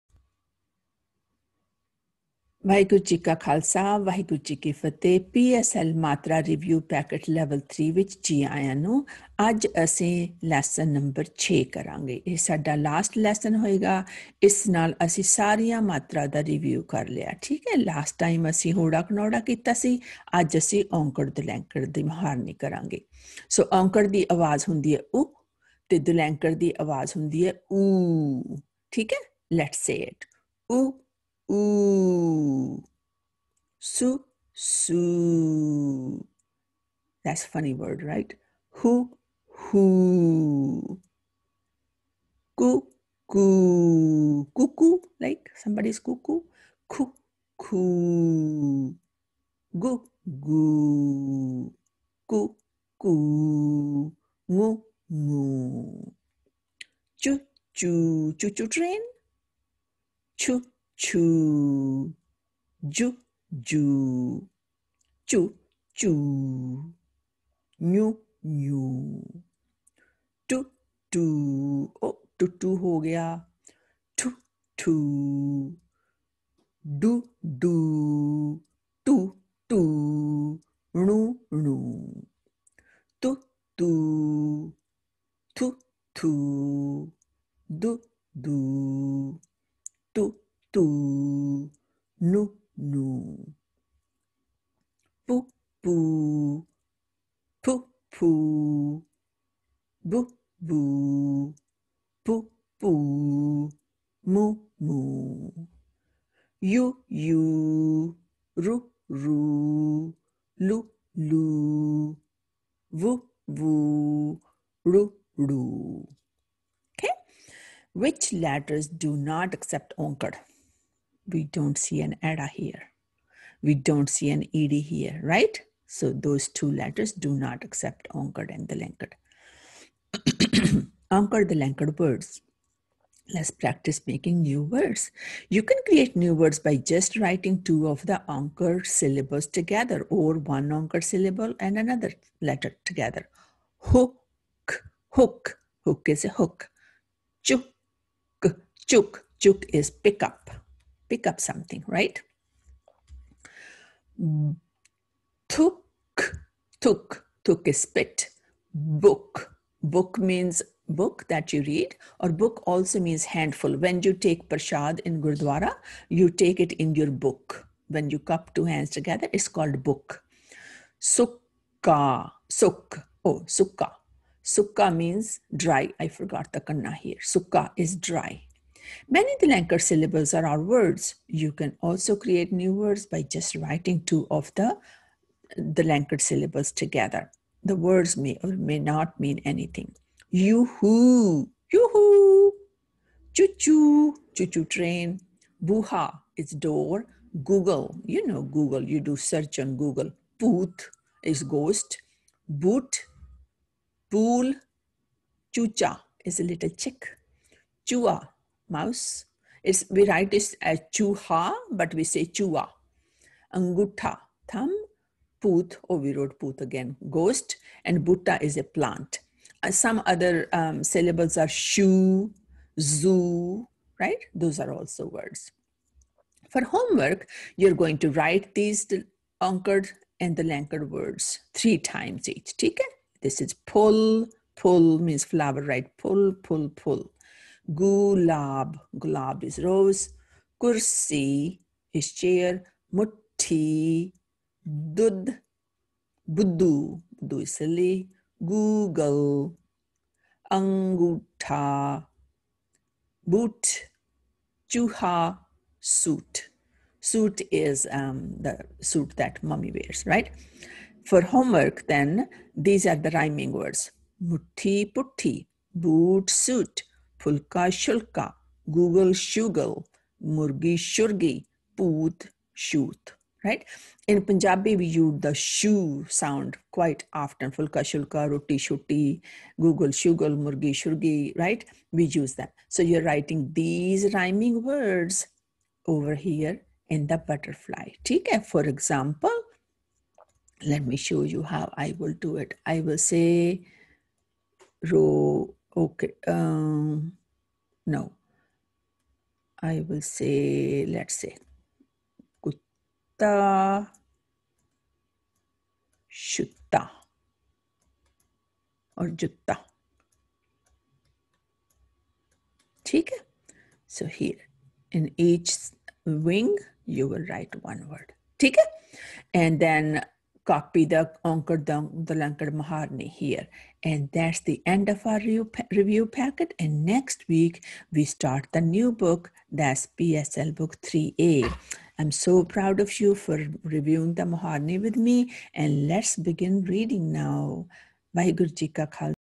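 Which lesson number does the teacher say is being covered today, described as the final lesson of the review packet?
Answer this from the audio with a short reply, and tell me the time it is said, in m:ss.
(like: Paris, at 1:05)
6, at 0:10.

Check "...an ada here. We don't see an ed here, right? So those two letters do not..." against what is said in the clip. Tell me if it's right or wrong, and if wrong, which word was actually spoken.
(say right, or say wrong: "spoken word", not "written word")
right.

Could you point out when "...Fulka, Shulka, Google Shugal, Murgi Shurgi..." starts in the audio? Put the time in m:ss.
4:27.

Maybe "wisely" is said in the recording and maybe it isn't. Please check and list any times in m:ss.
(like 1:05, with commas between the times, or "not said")
not said.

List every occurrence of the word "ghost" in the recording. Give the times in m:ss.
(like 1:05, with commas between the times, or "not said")
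3:21, 3:37.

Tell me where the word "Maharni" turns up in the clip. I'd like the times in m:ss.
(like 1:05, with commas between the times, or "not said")
5:22, 5:34.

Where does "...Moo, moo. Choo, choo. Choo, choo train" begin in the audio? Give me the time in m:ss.
0:54.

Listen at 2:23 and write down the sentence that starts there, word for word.
Hook, hook, hook is a hook.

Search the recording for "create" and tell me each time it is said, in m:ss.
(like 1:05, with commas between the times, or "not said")
2:15, 3:02.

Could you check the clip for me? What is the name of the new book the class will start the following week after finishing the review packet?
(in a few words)
PSL Book 3A.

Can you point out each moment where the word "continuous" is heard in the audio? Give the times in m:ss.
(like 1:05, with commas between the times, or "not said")
not said.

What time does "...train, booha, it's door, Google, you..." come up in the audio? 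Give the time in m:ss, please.
3:14.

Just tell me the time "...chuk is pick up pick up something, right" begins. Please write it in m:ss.
2:29.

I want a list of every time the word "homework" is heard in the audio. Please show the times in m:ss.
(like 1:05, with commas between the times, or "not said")
3:46, 4:21.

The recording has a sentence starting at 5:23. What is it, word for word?
And that's the end of our review, review packet.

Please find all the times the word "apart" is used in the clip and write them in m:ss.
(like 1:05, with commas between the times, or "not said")
not said.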